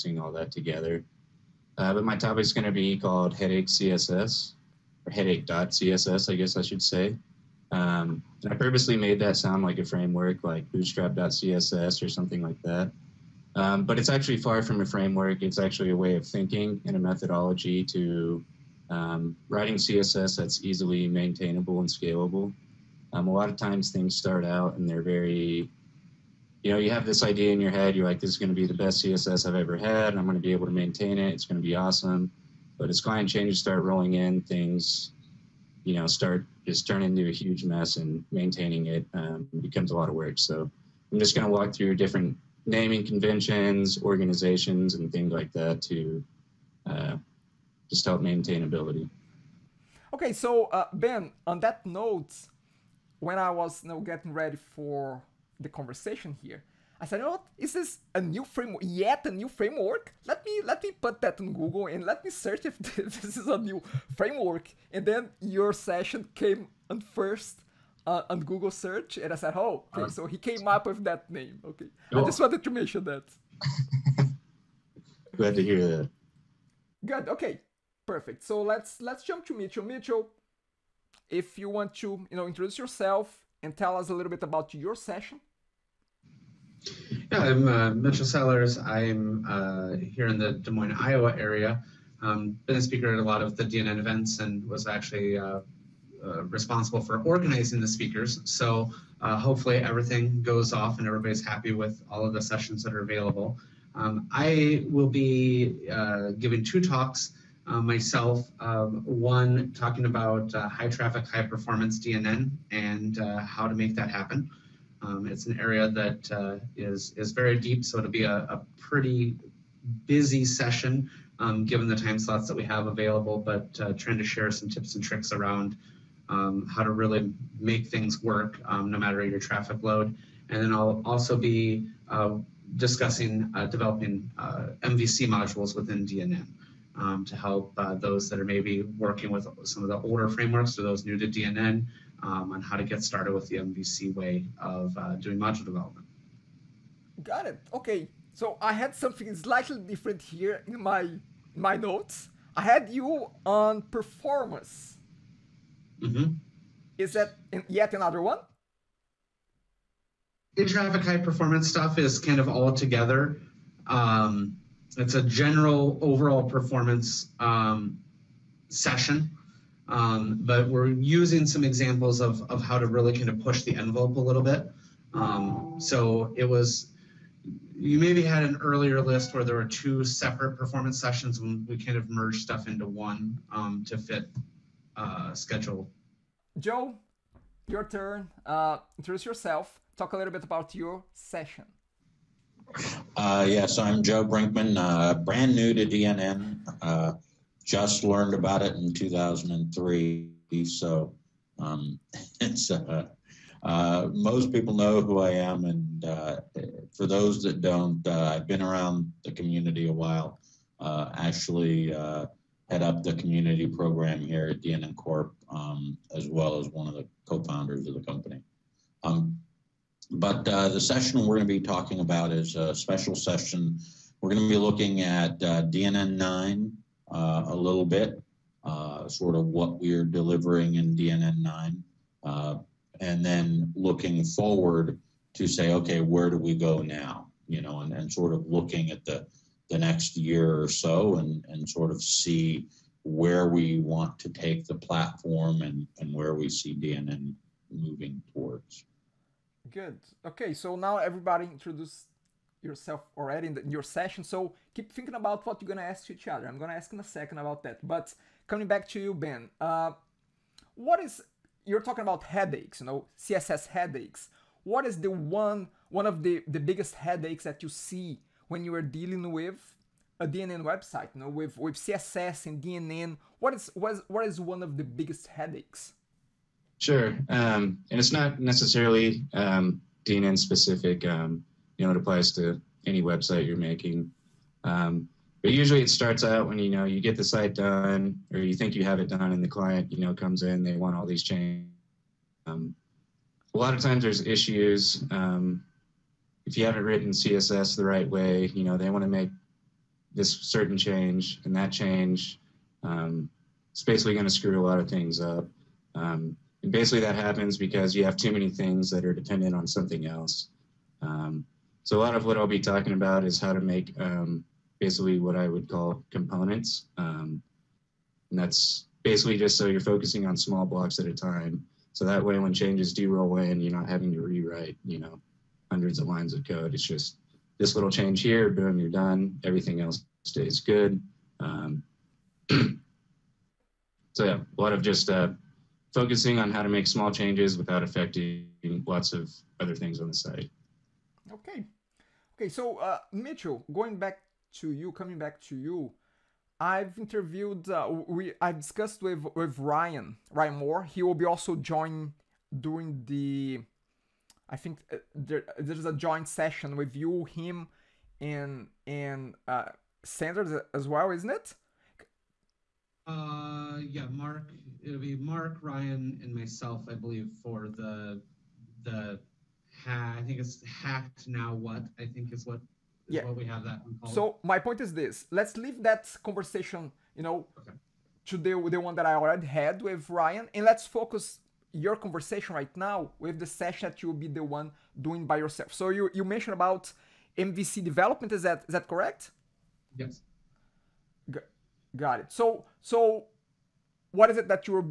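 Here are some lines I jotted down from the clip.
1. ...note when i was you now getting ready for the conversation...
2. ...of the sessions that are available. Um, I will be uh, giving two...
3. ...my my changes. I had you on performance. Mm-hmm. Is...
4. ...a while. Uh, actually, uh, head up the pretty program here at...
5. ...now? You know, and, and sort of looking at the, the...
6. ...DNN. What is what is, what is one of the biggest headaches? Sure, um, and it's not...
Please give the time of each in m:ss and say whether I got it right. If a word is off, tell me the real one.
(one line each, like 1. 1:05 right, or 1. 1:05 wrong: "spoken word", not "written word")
1. 0:51 right
2. 1:42 right
3. 2:30 wrong: "notes", not "changes"
4. 3:29 wrong: "community", not "pretty"
5. 3:56 right
6. 4:32 right.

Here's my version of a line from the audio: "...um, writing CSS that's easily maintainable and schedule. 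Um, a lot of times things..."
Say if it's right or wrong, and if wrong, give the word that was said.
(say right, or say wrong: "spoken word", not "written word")
wrong: "scalable", not "schedule".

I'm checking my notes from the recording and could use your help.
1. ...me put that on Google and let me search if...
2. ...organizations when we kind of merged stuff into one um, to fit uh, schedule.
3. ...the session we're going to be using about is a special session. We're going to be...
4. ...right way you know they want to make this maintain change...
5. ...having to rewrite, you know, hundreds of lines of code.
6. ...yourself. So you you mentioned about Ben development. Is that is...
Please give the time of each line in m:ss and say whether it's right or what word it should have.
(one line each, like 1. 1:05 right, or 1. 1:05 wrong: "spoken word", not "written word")
1. 1:00 right
2. 3:00 wrong: "sessions", not "organizations"
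3. 3:40 wrong: "talking", not "using"
4. 4:57 wrong: "certain", not "maintain"
5. 5:23 right
6. 6:25 wrong: "MVC", not "Ben".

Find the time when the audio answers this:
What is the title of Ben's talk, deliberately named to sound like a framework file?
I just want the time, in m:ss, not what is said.
0:05.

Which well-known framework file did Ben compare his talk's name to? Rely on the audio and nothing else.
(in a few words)
bootstrap.css.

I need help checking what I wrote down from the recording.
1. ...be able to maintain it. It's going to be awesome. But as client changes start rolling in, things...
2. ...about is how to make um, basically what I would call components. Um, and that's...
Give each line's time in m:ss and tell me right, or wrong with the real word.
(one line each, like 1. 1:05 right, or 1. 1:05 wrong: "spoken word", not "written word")
1. 0:30 right
2. 5:12 right.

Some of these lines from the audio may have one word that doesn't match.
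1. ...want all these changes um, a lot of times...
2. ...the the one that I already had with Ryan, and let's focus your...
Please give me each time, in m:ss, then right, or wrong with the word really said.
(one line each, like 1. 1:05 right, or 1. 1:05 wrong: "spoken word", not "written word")
1. 4:50 right
2. 6:18 right.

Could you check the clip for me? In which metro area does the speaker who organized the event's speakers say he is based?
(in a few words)
Des Moines, Iowa.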